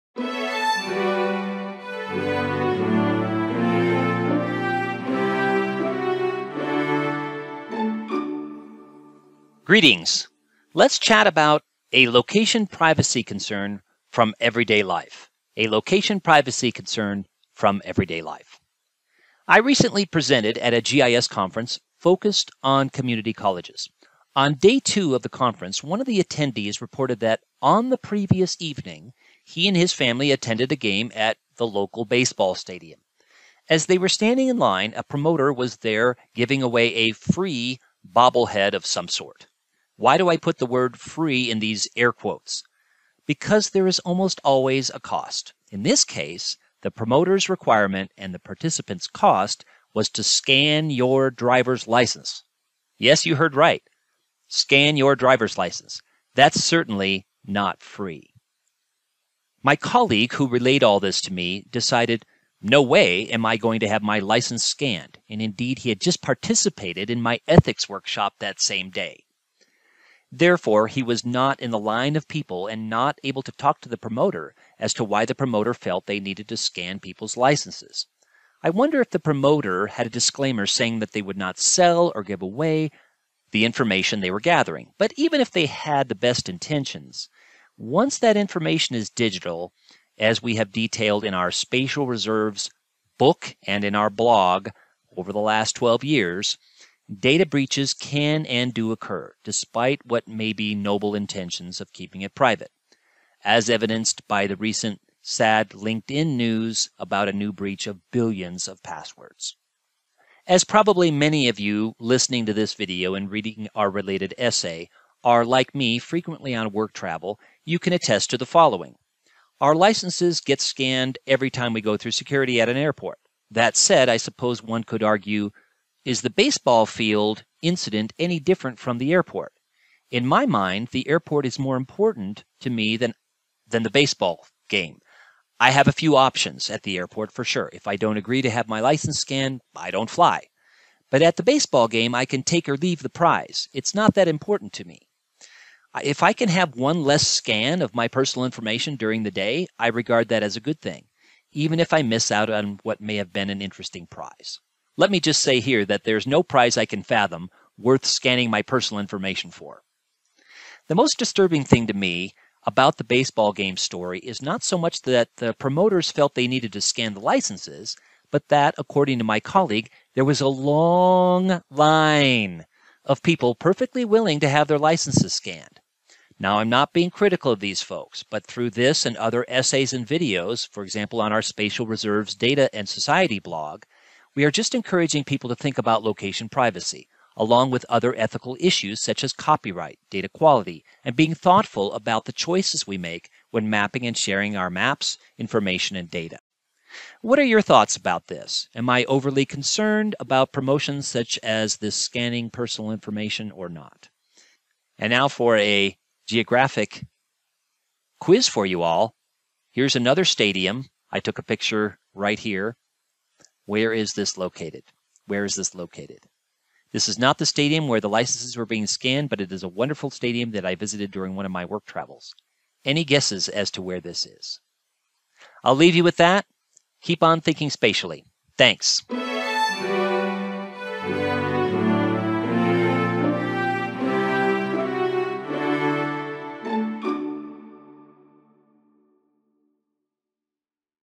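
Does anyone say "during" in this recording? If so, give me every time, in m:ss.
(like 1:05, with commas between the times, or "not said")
2:28, 3:41.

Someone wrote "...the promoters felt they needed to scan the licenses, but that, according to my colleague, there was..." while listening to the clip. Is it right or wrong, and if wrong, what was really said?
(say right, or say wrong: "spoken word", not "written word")
right.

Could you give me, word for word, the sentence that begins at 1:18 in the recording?
I wonder if the promoter had a disclaimer saying that they would not sell or give away the information they were gathering.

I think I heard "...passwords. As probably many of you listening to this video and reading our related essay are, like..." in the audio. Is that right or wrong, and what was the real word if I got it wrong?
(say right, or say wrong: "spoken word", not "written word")
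right.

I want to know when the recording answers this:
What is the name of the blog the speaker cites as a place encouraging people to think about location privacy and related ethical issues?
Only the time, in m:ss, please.
3:01.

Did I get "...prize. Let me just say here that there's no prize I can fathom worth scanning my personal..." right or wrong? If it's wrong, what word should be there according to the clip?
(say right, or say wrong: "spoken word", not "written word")
right.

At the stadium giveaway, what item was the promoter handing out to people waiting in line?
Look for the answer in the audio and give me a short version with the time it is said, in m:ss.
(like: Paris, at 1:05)
bobblehead, at 0:38.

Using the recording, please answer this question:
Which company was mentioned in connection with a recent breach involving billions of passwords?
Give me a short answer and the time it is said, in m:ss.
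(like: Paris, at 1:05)
LinkedIn, at 1:45.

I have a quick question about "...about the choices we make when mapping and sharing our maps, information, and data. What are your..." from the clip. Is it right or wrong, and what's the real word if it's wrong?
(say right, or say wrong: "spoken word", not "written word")
right.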